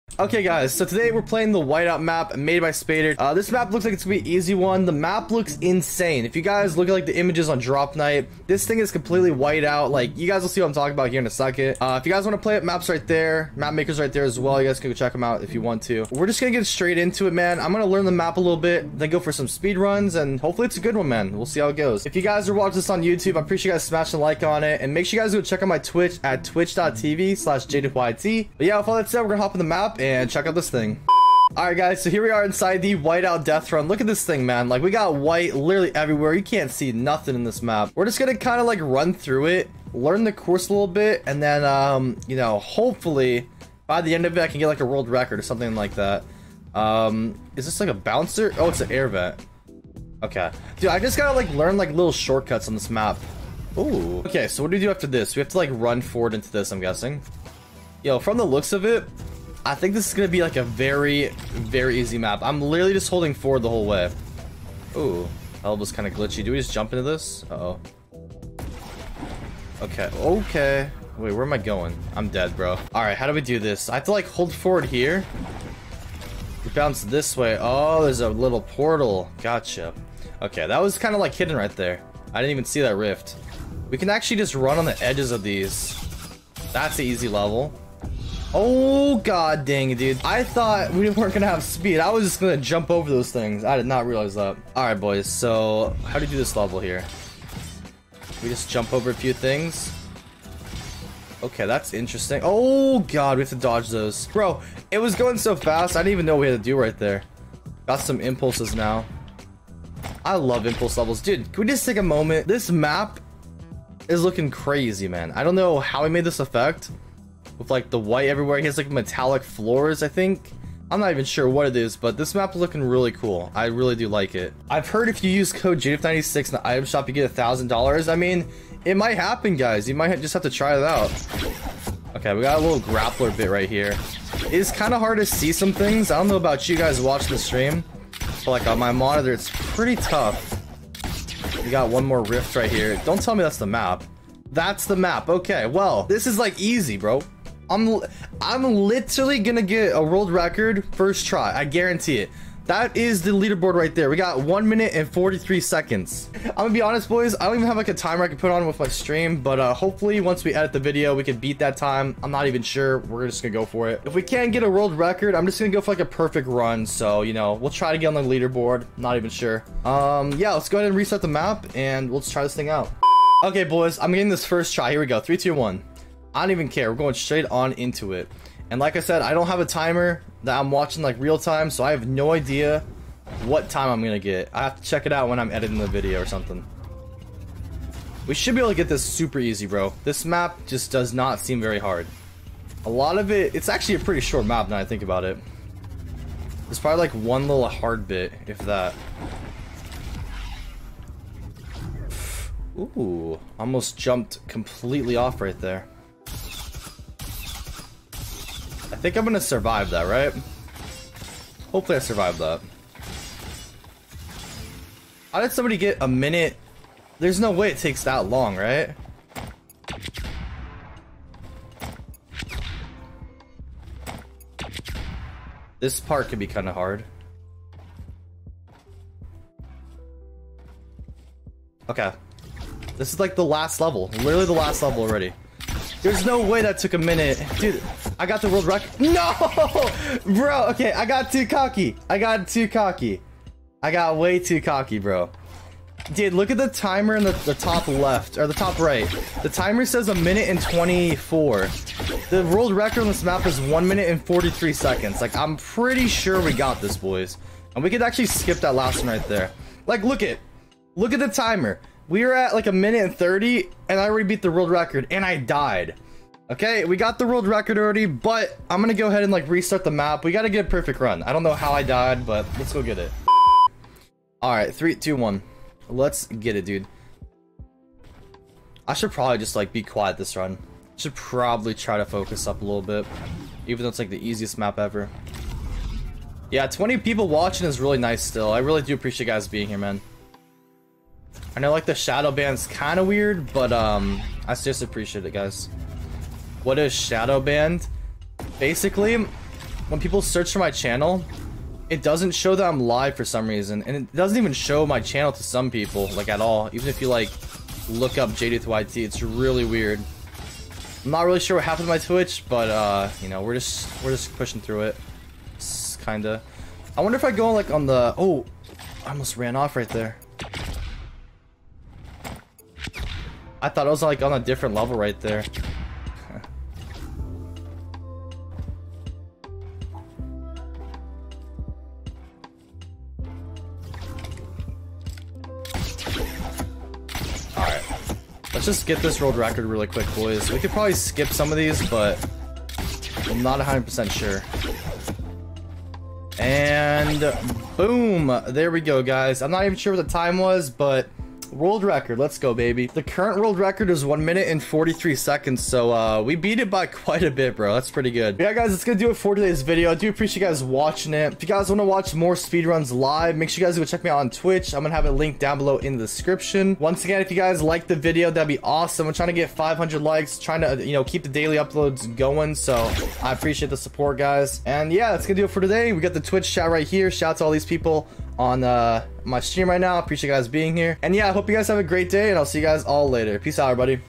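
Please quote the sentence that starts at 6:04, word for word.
I'm going to have a link down below in the description.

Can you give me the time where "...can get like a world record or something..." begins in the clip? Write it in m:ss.
0:44.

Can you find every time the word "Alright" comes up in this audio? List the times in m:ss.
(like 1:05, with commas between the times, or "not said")
0:31, 1:34.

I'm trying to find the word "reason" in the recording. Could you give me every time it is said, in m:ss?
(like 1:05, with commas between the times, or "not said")
5:03.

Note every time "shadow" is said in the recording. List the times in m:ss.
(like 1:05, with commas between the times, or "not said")
4:51, 4:56.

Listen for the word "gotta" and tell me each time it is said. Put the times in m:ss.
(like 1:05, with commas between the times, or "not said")
0:51, 4:30.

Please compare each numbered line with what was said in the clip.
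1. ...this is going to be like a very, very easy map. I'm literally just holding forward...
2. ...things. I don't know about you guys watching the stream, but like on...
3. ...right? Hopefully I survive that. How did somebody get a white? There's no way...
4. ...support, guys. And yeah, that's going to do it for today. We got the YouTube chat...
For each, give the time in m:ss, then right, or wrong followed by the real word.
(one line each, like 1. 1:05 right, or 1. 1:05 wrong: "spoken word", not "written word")
1. 0:59 right
2. 2:15 right
3. 3:30 wrong: "minute", not "white"
4. 6:13 wrong: "Twitch", not "YouTube".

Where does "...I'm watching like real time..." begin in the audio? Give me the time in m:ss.
3:00.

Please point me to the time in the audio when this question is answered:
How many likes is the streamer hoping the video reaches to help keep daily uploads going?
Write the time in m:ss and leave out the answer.
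6:09.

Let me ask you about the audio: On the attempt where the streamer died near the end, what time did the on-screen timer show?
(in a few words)
1 minute 24.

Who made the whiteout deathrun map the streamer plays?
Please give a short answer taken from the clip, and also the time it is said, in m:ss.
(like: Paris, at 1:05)
Spader, at 0:02.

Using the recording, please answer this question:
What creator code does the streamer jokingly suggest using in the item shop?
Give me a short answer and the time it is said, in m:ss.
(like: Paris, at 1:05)
JDuth96, at 2:05.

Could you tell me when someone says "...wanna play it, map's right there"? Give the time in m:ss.
0:12.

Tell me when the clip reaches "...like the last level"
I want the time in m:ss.
3:53.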